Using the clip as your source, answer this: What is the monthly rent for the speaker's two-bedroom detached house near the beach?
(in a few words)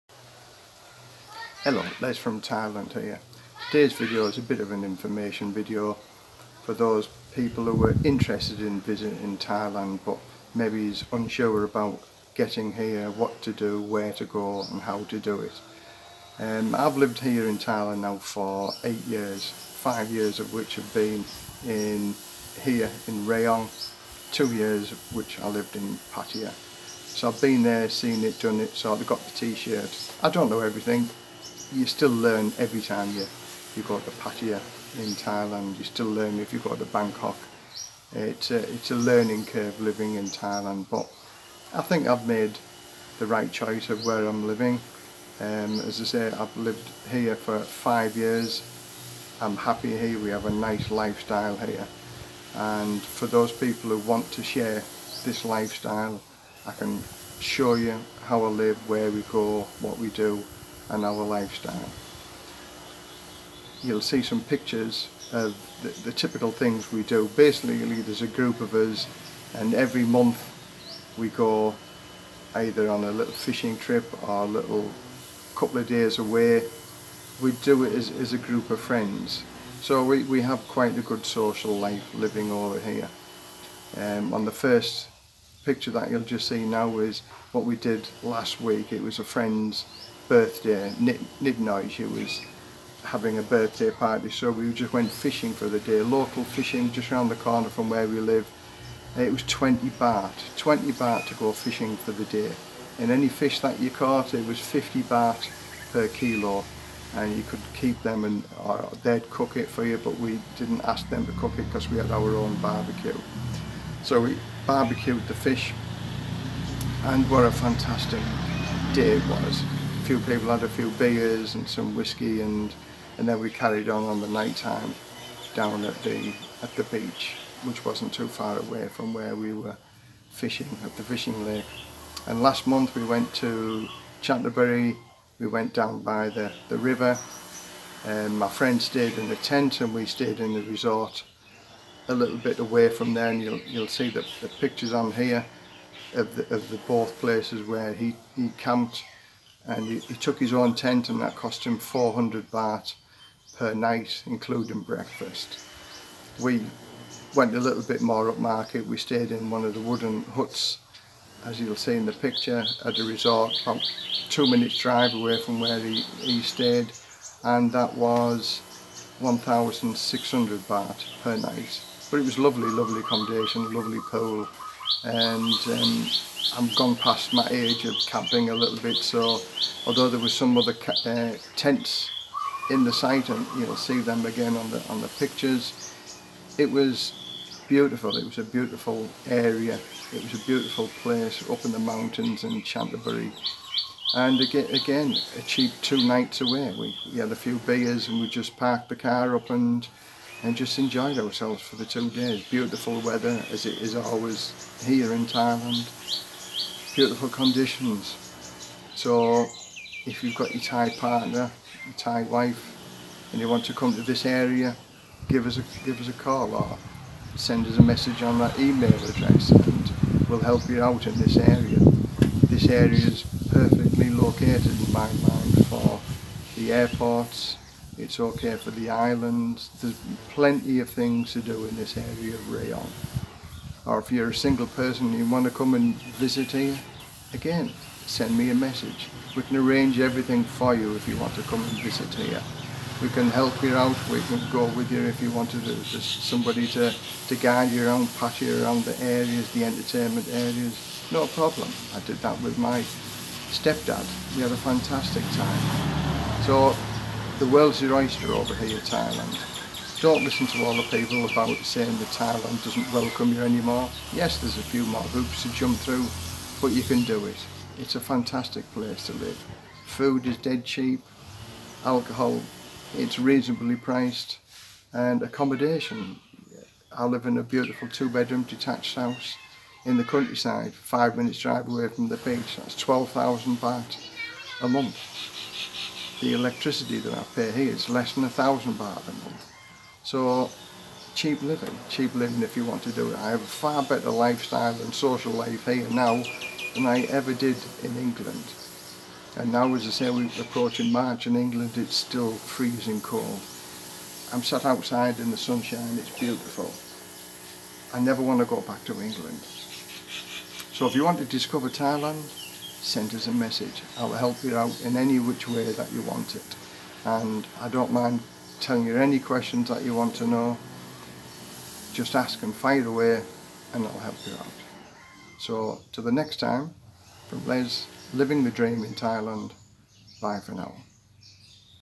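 12,000 baht.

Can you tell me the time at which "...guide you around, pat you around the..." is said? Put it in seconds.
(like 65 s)
247 s.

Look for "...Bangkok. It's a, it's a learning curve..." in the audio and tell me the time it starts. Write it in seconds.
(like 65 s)
36 s.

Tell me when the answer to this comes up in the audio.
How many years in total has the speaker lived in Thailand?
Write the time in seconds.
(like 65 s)
18 s.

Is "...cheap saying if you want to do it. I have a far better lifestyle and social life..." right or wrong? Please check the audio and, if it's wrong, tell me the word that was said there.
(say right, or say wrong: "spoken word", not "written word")
wrong: "living", not "saying".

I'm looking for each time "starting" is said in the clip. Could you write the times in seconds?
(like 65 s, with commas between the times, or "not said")
not said.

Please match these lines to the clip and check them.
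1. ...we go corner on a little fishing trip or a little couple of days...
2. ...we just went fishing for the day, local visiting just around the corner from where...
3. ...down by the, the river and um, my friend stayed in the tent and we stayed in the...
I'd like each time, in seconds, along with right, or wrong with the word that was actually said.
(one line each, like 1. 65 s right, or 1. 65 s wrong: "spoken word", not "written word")
1. 71 s wrong: "either", not "corner"
2. 94 s wrong: "fishing", not "visiting"
3. 135 s right.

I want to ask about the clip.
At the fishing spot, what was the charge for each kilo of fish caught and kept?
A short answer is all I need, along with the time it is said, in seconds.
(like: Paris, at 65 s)
50 baht, at 104 s.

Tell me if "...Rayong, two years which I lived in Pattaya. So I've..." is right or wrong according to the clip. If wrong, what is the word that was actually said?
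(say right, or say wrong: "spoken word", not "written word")
right.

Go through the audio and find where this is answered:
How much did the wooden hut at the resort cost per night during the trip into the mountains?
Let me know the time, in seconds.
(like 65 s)
169 s.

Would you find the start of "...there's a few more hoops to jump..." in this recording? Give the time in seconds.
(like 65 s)
264 s.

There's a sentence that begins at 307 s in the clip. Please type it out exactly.
I never want to go back to England.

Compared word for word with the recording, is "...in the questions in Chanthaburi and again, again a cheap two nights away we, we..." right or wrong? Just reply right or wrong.
wrong.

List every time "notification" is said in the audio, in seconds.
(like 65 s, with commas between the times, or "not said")
not said.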